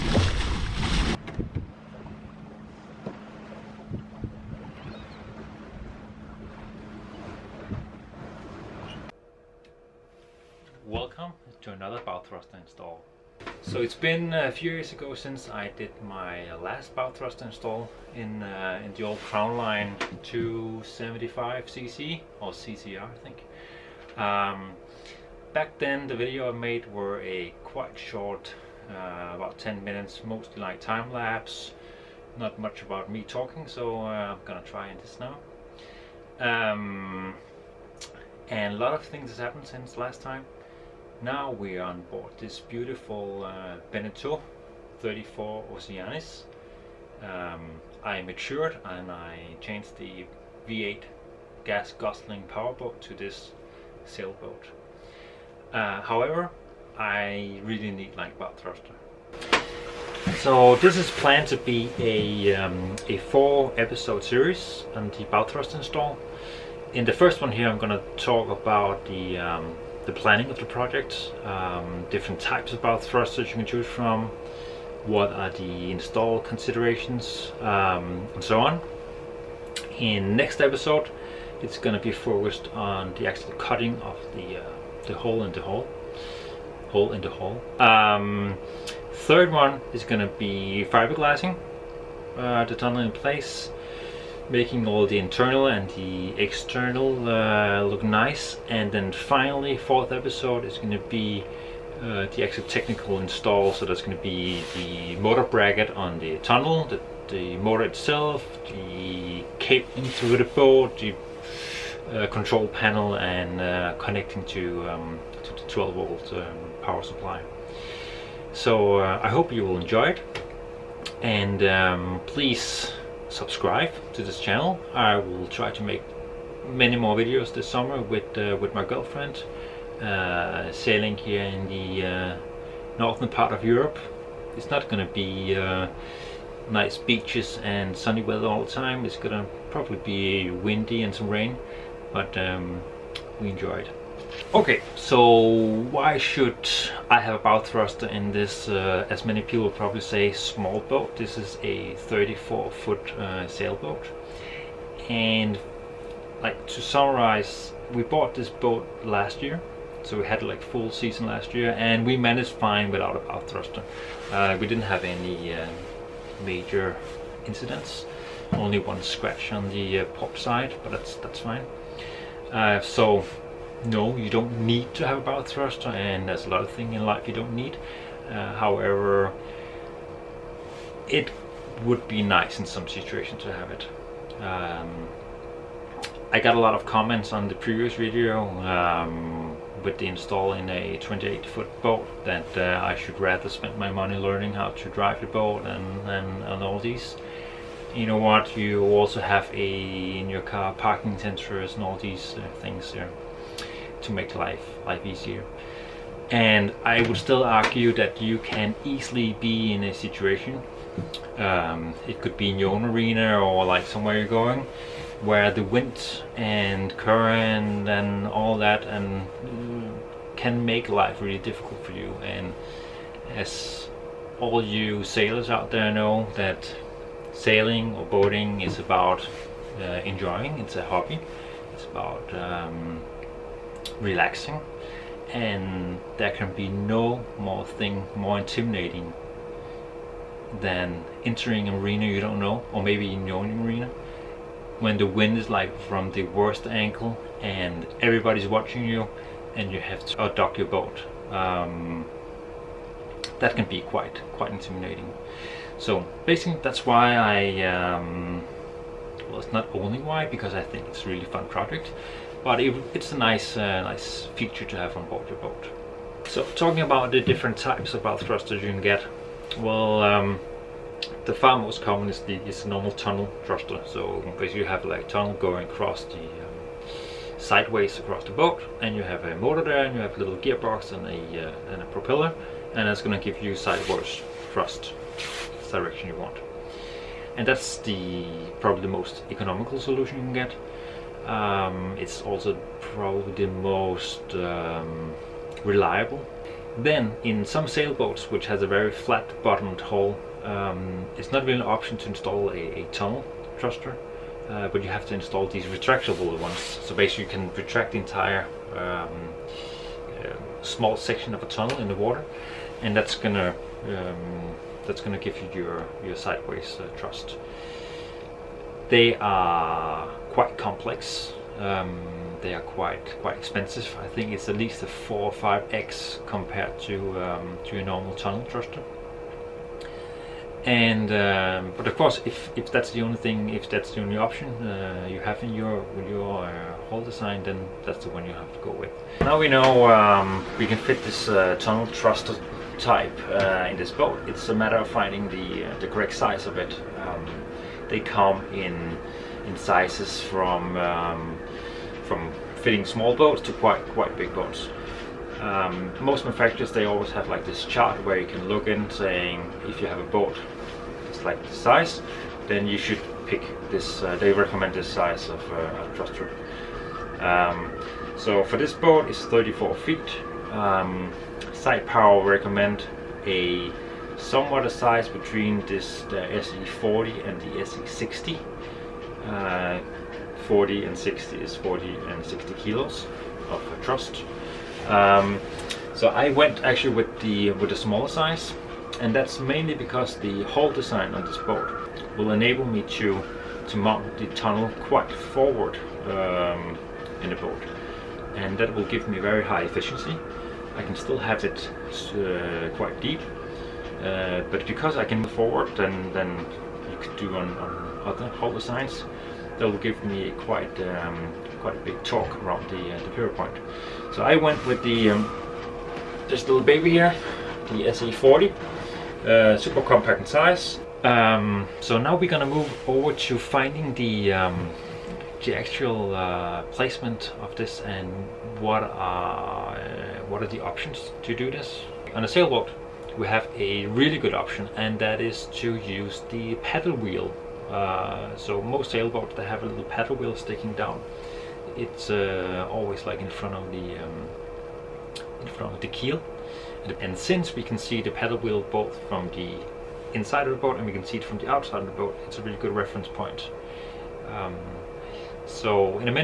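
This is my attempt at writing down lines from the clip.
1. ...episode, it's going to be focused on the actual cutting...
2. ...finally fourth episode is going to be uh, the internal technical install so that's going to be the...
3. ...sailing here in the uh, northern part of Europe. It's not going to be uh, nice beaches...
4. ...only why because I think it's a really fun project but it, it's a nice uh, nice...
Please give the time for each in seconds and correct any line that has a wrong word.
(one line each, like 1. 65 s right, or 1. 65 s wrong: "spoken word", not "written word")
1. 80 s right
2. 99 s wrong: "actual", not "internal"
3. 130 s right
4. 259 s right.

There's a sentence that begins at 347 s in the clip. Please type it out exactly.
Um, they come in in sizes from um, from fitting small boats to quite quite big boats.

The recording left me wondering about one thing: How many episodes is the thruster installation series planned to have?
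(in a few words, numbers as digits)
4.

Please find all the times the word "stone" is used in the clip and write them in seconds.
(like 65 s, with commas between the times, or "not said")
not said.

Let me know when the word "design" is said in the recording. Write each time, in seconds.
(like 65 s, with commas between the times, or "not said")
337 s, 390 s, 408 s.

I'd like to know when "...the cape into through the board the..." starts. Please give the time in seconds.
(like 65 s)
108 s.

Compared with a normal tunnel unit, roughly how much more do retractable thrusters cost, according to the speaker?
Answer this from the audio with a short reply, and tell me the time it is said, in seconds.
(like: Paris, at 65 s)
4 or 5 times, at 324 s.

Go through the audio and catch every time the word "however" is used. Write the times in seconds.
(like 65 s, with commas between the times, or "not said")
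56 s, 178 s.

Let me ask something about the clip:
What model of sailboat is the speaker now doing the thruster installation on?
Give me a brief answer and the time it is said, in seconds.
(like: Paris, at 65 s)
Beneteau 34 Oceanis, at 43 s.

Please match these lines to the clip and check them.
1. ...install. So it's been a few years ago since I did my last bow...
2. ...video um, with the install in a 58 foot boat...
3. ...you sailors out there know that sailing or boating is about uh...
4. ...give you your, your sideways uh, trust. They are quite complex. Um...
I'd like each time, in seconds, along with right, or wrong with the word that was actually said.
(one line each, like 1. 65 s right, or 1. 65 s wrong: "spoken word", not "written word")
1. 12 s right
2. 187 s wrong: "28", not "58"
3. 224 s right
4. 315 s wrong: "thrust", not "trust".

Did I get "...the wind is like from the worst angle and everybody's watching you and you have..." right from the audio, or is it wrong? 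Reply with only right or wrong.
right.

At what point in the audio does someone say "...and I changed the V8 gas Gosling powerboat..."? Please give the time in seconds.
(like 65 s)
48 s.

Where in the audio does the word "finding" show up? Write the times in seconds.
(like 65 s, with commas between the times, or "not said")
344 s, 423 s.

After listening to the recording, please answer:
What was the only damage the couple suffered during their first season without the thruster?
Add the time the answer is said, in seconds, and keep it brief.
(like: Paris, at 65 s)
One scratch, at 168 s.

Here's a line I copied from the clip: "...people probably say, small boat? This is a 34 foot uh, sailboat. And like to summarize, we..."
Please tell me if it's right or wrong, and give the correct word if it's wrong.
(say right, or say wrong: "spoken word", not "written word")
right.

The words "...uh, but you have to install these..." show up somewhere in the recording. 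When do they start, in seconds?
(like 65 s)
304 s.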